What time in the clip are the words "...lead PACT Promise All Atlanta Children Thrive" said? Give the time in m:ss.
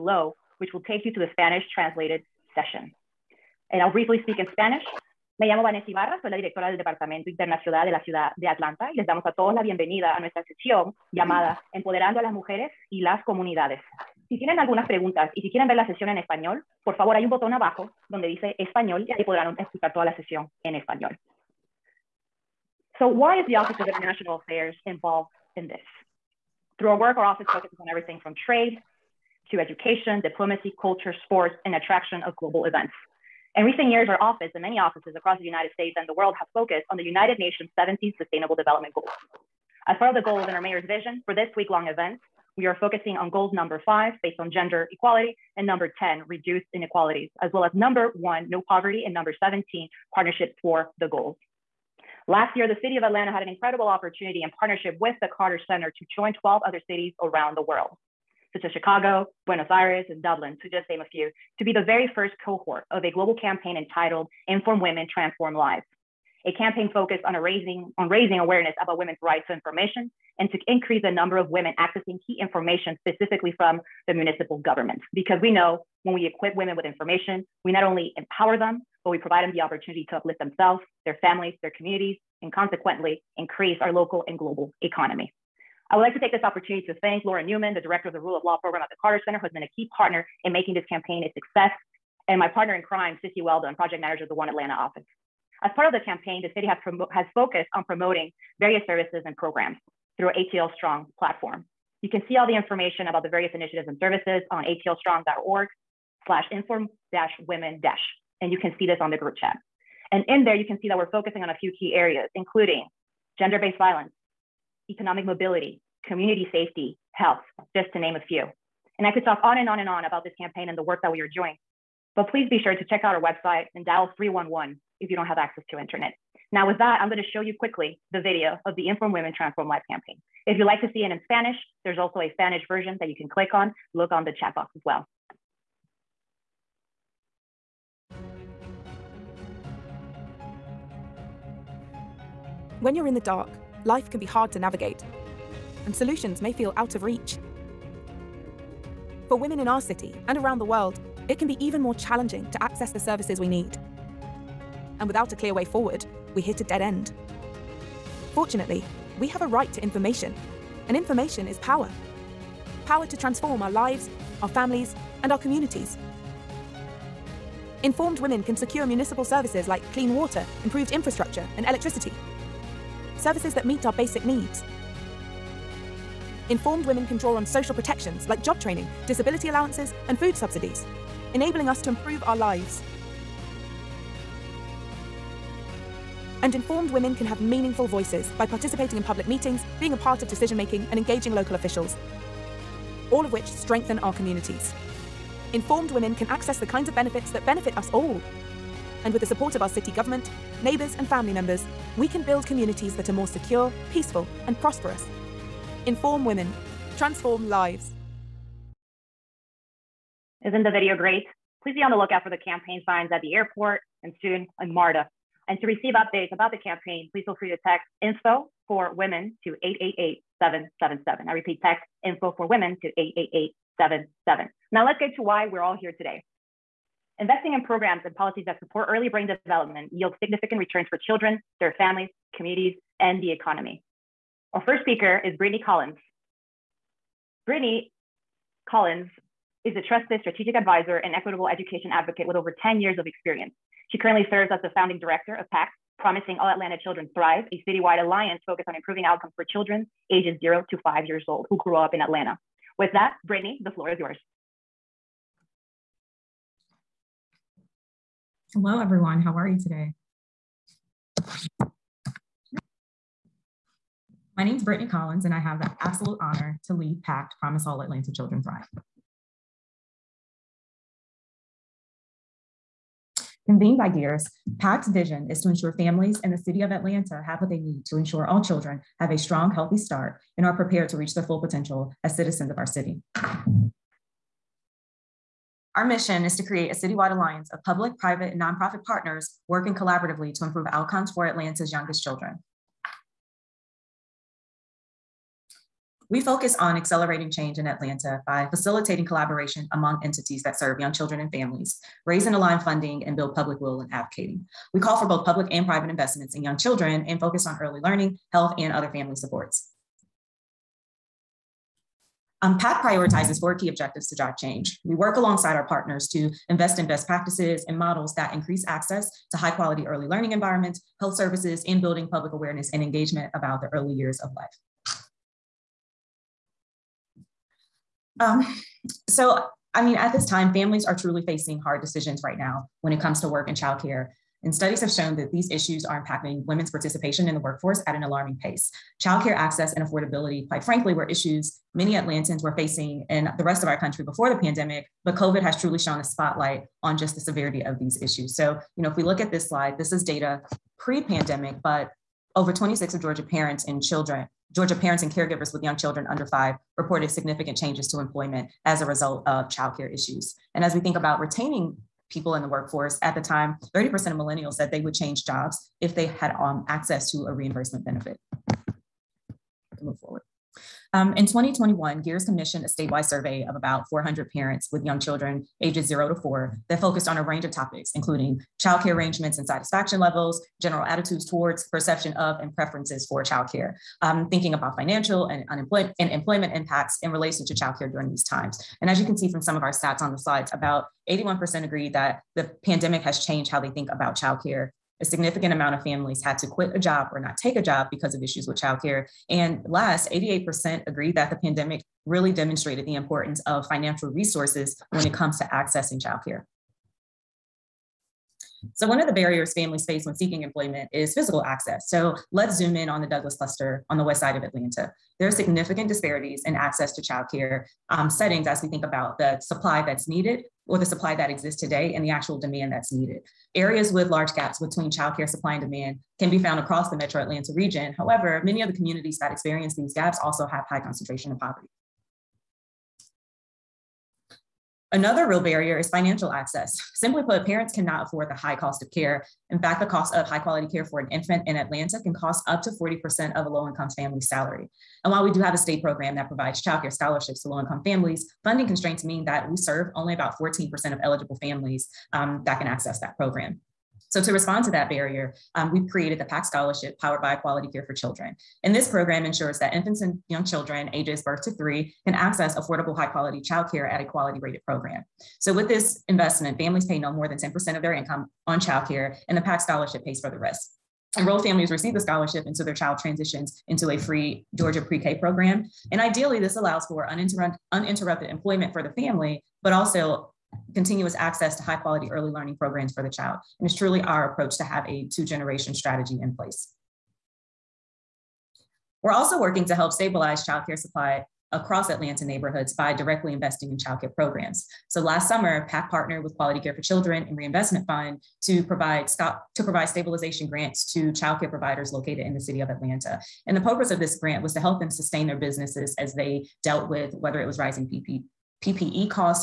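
4:26.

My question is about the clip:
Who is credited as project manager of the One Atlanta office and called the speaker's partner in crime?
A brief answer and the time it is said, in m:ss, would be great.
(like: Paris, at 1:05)
Sissy Weldon, at 1:33.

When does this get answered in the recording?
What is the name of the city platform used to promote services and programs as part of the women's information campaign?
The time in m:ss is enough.
1:40.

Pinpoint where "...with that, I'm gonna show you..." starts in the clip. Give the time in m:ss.
2:06.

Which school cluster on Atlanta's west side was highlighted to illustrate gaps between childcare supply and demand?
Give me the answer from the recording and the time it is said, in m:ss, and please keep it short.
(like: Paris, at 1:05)
Douglas cluster, at 6:53.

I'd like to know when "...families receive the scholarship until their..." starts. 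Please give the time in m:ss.
7:51.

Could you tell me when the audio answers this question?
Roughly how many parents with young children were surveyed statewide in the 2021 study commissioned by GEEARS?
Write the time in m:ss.
6:13.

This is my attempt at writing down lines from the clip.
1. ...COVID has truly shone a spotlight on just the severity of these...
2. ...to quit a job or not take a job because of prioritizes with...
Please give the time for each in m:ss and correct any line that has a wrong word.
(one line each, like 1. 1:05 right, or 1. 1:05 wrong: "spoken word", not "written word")
1. 5:45 right
2. 6:36 wrong: "issues", not "prioritizes".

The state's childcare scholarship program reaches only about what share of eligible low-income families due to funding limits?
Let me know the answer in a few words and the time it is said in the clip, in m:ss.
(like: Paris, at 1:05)
14%, at 7:30.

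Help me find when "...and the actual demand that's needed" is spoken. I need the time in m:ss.
7:01.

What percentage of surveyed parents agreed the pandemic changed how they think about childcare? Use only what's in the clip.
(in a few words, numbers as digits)
81%.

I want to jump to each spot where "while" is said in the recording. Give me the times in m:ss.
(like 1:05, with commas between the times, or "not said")
7:25.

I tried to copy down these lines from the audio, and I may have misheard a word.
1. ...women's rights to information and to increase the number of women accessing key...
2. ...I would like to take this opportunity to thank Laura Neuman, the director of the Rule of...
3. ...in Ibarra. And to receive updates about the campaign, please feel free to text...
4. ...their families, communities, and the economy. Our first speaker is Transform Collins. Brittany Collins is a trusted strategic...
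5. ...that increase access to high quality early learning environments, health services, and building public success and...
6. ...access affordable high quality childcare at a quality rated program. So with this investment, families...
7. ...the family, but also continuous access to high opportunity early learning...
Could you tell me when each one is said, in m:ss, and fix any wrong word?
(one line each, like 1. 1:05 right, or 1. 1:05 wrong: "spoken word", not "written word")
1. 1:08 right
2. 1:25 right
3. 3:34 wrong: "MARTA", not "Ibarra"
4. 3:51 wrong: "Brittany", not "Transform"
5. 5:18 wrong: "awareness", not "success"
6. 7:42 right
7. 7:58 wrong: "quality", not "opportunity".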